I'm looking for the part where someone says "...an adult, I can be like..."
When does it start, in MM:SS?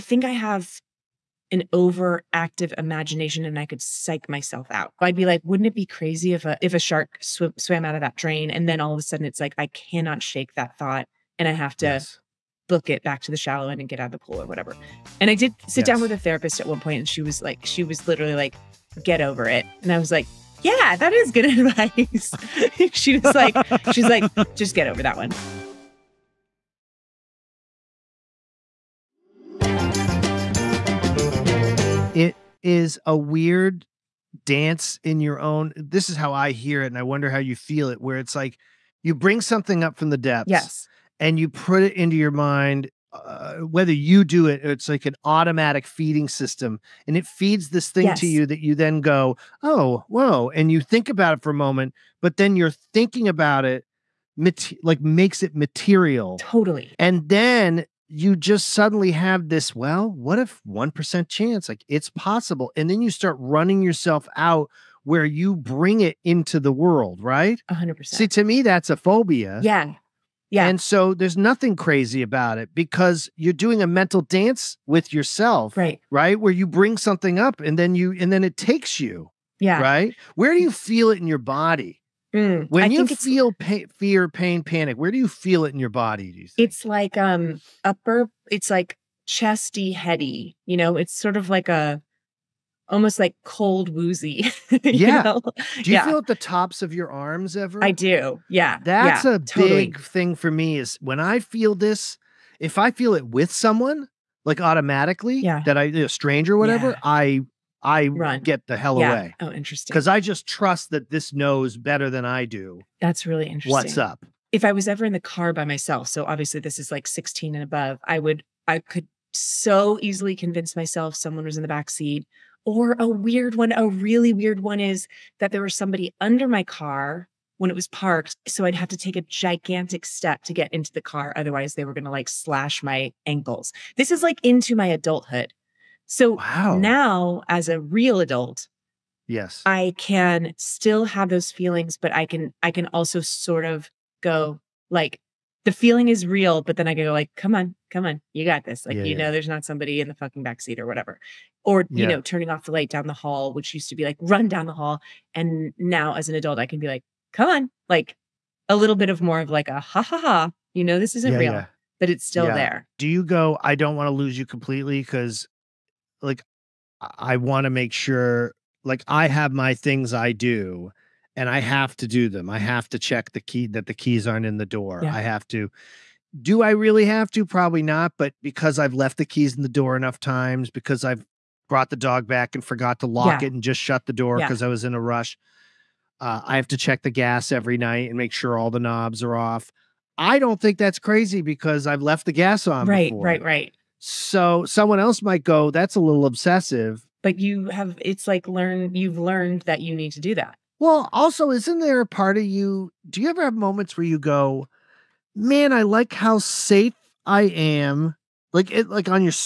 02:36.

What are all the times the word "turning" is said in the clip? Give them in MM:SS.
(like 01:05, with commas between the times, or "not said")
02:32.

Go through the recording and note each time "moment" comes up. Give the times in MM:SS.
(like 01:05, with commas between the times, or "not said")
00:51, 03:23.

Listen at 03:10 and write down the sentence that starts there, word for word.
I don't think that's crazy because I've left the gas on.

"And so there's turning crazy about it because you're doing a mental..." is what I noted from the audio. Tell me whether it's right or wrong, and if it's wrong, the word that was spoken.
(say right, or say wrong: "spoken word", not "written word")
wrong: "nothing", not "turning".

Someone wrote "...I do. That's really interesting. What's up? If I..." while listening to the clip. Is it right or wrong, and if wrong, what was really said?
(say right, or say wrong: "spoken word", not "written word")
right.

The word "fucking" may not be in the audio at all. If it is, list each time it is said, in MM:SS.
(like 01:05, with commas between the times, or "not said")
02:30.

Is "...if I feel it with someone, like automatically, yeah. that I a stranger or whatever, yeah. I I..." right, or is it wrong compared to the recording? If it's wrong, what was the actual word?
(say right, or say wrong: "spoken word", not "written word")
right.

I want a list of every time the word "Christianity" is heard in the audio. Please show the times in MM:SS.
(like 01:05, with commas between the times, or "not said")
not said.